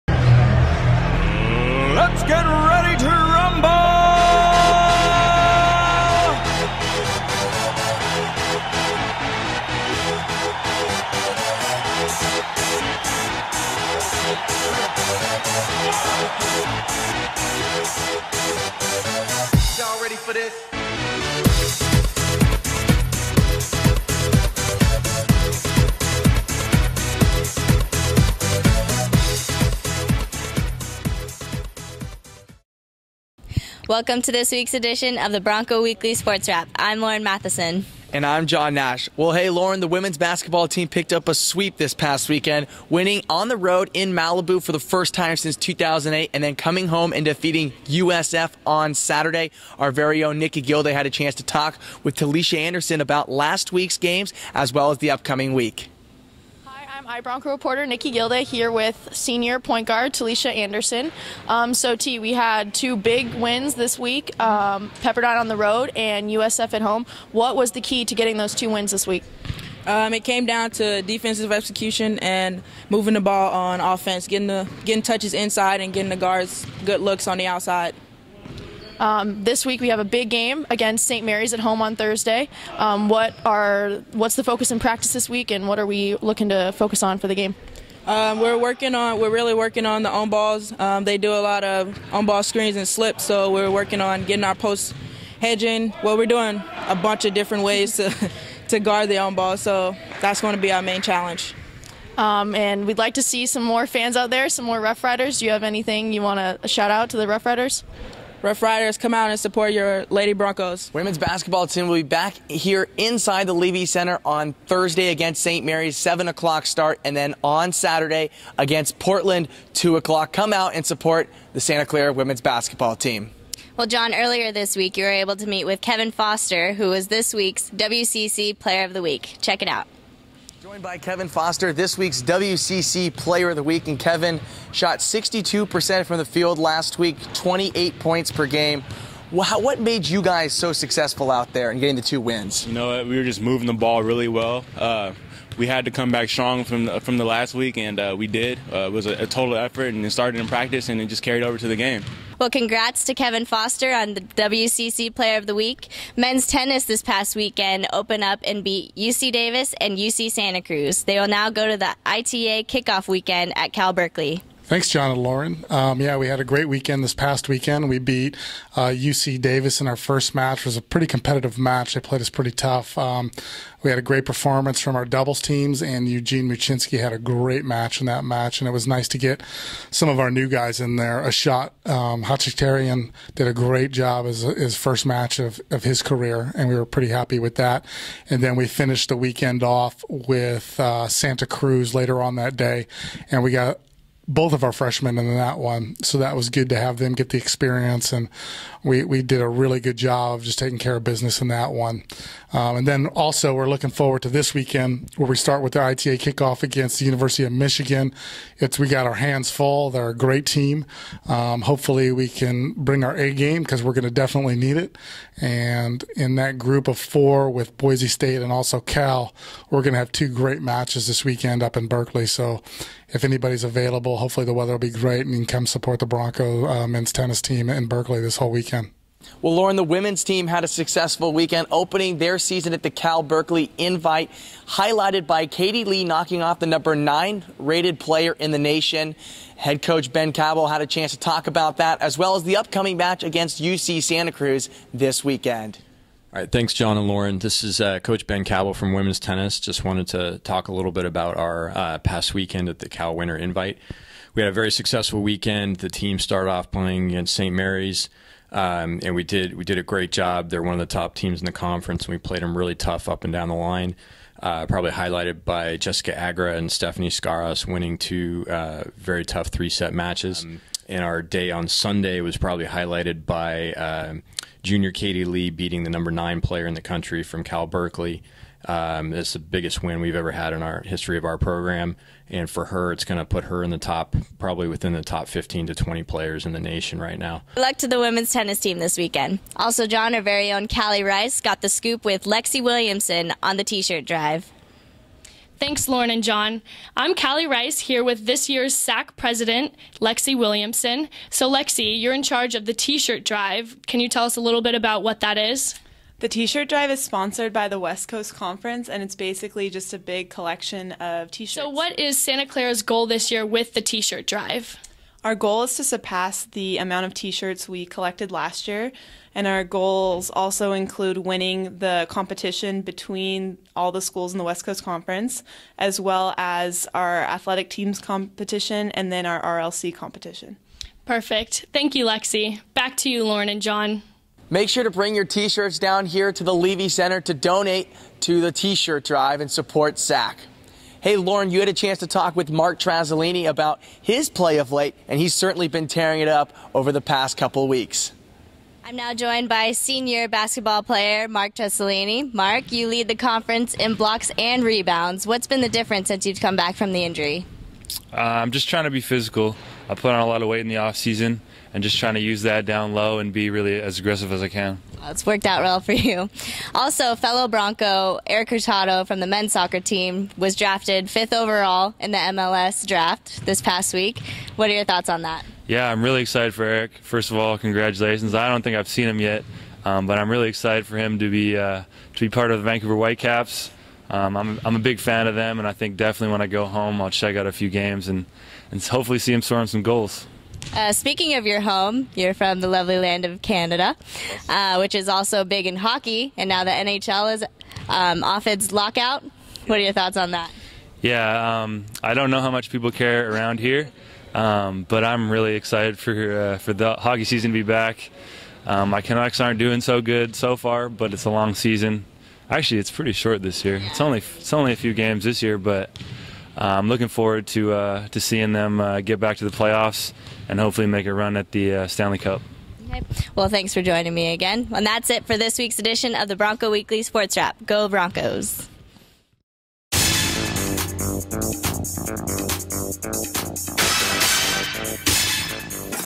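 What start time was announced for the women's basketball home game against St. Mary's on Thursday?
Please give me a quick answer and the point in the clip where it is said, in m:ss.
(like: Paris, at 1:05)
7 o'clock, at 1:55.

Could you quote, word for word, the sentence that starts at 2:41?
They will now go to the ITA kickoff weekend at Cal Berkeley.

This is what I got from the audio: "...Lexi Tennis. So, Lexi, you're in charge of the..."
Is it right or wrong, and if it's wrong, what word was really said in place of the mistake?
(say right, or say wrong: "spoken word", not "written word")
wrong: "Williamson", not "Tennis".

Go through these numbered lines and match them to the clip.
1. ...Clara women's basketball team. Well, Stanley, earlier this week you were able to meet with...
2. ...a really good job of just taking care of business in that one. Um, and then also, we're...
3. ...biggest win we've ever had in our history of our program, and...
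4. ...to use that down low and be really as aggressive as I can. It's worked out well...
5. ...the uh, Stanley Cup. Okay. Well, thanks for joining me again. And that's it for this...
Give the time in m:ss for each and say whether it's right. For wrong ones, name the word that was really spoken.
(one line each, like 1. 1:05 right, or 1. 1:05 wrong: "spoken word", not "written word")
1. 2:01 wrong: "John", not "Stanley"
2. 3:19 right
3. 4:39 right
4. 6:02 right
5. 7:01 right.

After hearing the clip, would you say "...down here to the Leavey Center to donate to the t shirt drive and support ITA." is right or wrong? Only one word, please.
wrong.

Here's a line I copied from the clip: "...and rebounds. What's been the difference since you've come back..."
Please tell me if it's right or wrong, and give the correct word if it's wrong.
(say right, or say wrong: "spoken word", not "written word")
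right.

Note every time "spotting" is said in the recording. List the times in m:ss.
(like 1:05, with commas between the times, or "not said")
not said.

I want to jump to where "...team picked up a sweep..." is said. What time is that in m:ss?
0:40.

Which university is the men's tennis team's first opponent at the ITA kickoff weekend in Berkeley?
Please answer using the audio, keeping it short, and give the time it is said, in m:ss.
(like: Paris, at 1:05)
University of Michigan, at 3:27.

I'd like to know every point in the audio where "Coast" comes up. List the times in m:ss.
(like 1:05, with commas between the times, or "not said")
5:08, 5:24.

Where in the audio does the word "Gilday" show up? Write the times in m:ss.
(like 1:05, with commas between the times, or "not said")
0:50, 0:58.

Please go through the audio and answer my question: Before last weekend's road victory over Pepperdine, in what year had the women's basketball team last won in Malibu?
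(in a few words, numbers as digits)
2008.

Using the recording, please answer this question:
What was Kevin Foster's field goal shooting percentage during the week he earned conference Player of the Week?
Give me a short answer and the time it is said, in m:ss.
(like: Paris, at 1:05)
62%, at 2:14.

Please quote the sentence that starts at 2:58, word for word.
And it was nice to get some of our new guys in there a shot.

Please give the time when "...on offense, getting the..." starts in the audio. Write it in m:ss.
1:13.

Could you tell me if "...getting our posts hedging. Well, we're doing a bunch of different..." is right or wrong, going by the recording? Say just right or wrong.
right.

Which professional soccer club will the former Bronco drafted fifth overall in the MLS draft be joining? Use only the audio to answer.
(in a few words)
Vancouver Whitecaps.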